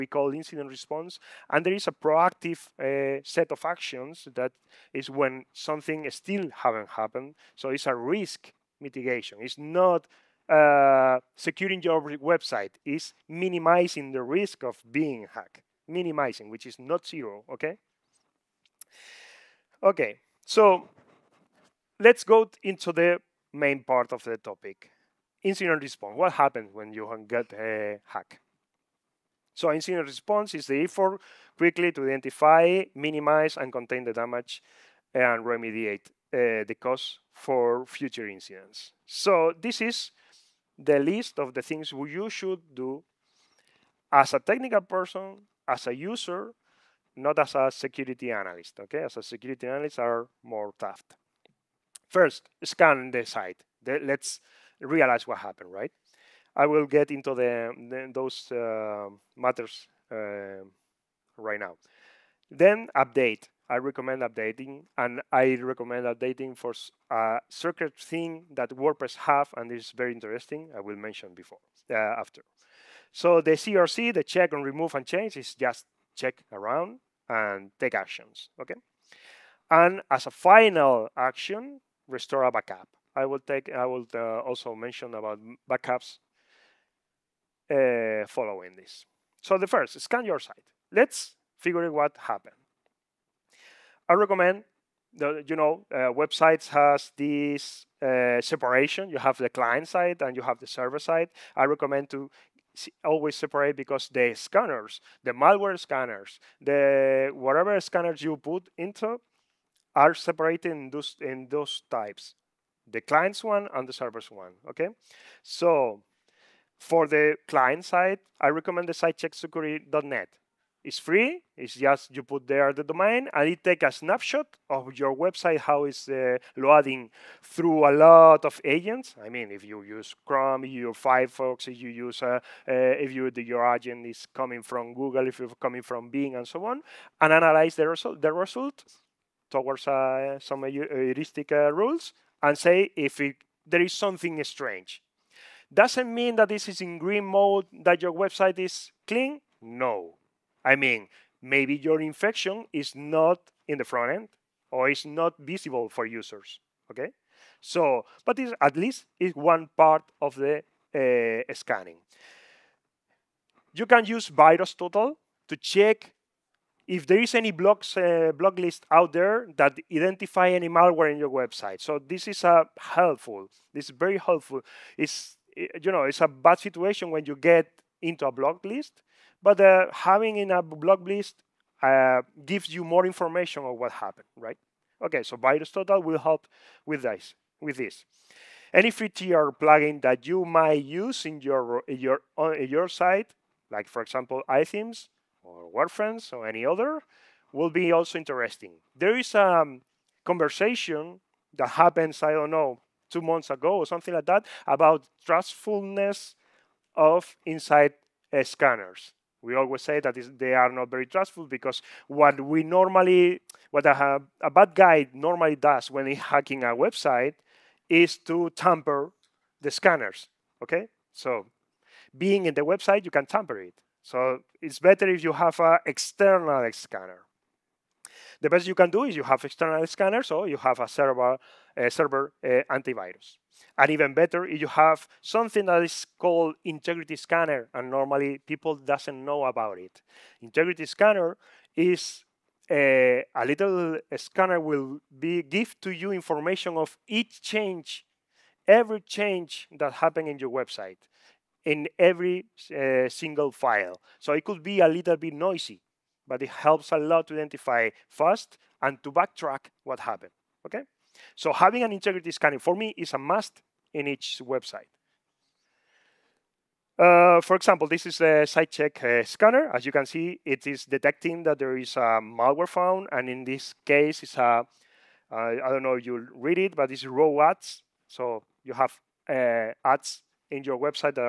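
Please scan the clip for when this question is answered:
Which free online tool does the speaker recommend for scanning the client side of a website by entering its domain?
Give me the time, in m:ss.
1:58.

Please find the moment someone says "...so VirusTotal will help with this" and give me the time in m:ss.
3:05.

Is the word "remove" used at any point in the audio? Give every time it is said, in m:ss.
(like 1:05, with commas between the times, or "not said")
1:14.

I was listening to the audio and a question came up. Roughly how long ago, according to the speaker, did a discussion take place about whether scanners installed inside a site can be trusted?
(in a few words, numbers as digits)
Two months ago.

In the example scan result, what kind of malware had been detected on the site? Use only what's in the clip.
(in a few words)
Raw ads.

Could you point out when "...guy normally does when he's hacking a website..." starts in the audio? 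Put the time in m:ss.
3:34.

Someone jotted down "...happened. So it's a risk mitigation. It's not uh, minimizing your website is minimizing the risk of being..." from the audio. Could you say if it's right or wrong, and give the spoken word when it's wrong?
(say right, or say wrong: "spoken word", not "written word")
wrong: "securing", not "minimizing".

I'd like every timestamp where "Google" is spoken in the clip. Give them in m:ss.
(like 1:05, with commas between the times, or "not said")
2:14.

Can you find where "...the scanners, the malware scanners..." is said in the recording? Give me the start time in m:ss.
1:44.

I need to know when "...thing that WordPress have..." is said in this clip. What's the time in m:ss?
1:07.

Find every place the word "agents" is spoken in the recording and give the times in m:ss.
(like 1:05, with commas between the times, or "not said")
2:08, 2:13.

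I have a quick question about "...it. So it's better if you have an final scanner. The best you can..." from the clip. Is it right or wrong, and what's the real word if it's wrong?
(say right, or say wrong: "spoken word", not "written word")
wrong: "external", not "final".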